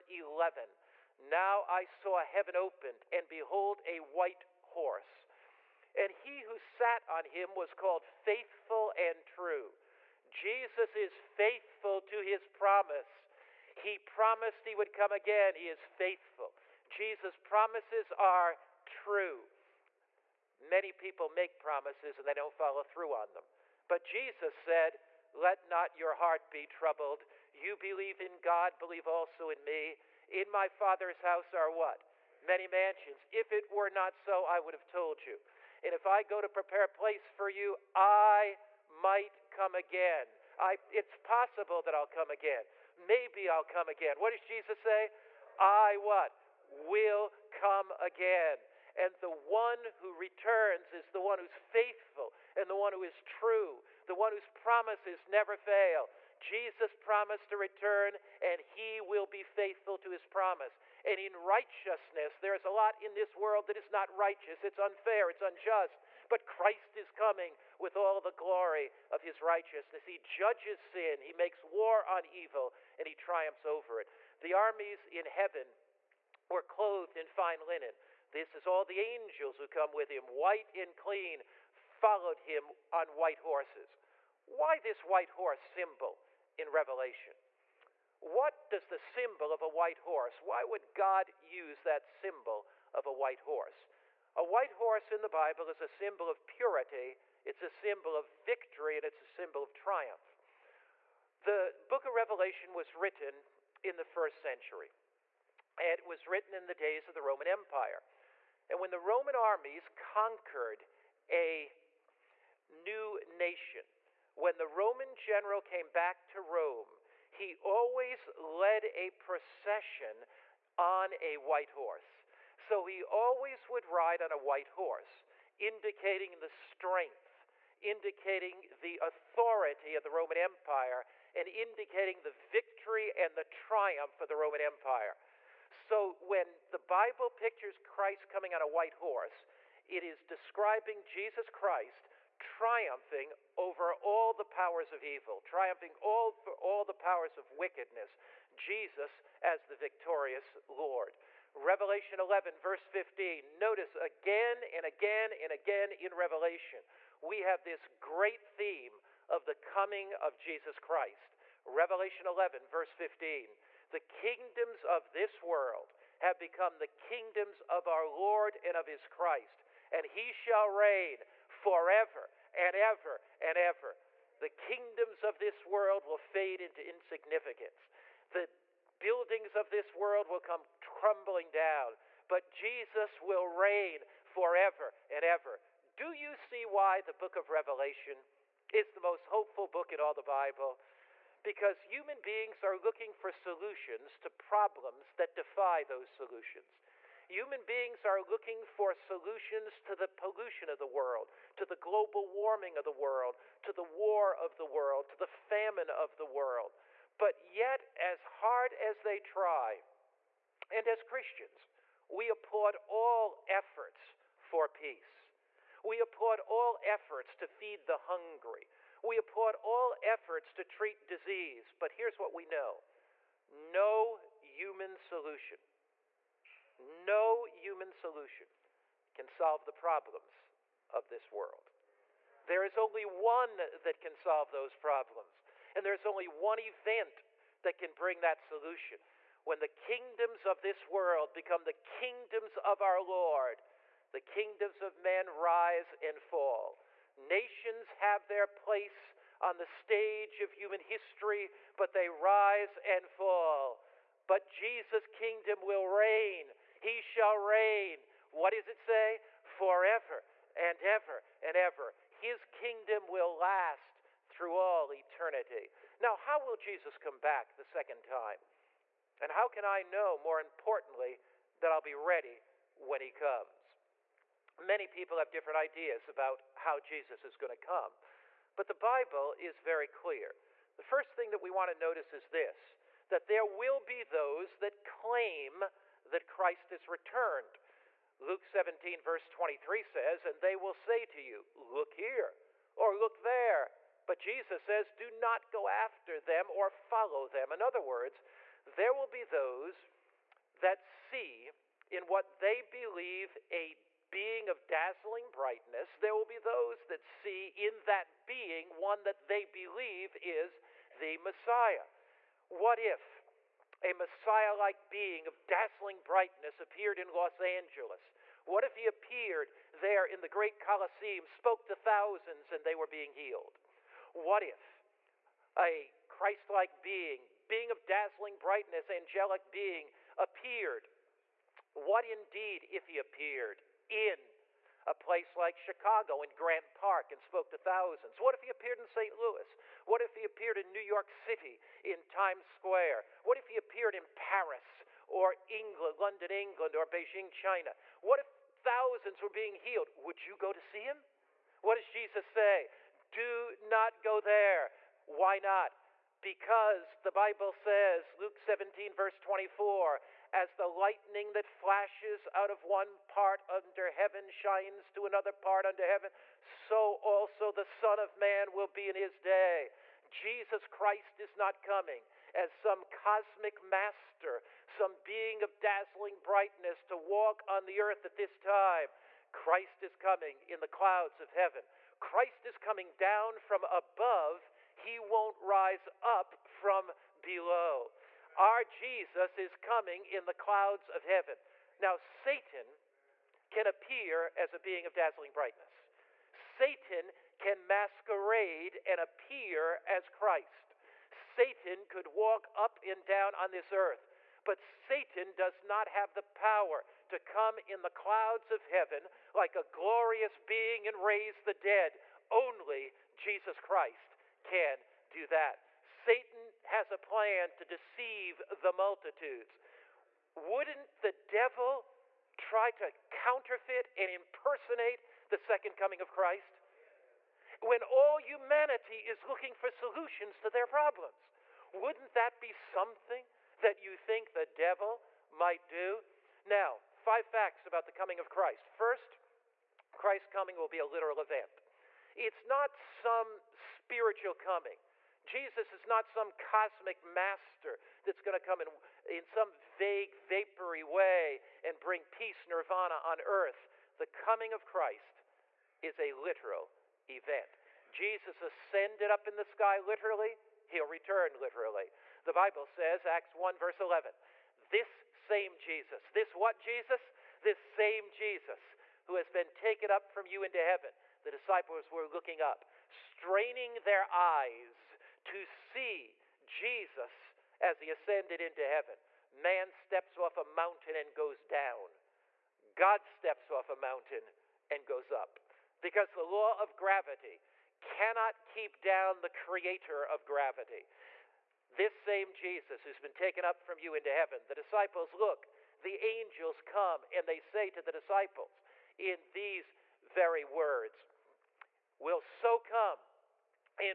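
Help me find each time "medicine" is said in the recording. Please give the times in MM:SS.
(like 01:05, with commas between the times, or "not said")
not said.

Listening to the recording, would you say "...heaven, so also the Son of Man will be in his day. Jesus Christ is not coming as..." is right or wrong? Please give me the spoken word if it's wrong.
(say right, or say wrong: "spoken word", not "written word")
right.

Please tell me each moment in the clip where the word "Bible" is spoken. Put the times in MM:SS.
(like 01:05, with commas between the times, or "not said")
01:35, 02:16, 03:10, 04:38, 05:57, 07:42.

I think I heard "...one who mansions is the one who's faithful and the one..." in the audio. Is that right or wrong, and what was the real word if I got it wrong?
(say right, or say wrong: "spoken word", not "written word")
wrong: "returns", not "mansions".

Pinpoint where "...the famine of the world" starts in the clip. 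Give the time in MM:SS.
03:25.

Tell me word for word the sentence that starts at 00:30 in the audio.
In my Father's house are what?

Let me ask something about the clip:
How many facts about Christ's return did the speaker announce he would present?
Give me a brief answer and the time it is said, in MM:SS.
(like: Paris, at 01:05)
5, at 07:17.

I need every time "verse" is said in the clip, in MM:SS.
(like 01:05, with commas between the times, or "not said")
02:32, 02:42, 04:49, 05:58, 07:43.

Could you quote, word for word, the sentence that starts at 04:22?
His kingdom will last through all eternity.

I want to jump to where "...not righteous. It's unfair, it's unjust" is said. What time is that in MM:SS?
01:03.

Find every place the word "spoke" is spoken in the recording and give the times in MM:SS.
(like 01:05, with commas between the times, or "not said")
05:21, 05:37.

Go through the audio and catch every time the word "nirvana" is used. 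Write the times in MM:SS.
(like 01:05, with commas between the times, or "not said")
07:32.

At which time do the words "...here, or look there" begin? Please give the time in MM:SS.
04:51.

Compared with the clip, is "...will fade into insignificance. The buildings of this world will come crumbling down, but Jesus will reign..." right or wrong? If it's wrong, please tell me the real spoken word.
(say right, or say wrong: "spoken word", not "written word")
right.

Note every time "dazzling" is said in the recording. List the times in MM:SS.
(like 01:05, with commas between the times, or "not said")
05:04, 05:15, 05:27, 06:15, 06:34.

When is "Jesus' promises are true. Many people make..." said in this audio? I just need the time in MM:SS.
00:16.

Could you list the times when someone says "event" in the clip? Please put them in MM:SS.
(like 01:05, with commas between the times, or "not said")
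03:56, 07:21, 07:37.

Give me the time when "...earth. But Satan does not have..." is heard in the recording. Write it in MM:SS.
06:43.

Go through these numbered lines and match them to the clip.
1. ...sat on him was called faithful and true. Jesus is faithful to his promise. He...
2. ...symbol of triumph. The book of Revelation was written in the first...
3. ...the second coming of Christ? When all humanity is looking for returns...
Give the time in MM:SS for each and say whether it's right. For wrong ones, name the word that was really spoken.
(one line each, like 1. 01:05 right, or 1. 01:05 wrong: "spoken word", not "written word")
1. 00:06 right
2. 01:39 right
3. 07:05 wrong: "solutions", not "returns".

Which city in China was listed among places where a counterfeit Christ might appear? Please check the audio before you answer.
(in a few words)
Beijing.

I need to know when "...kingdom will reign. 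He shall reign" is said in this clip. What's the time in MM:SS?
04:15.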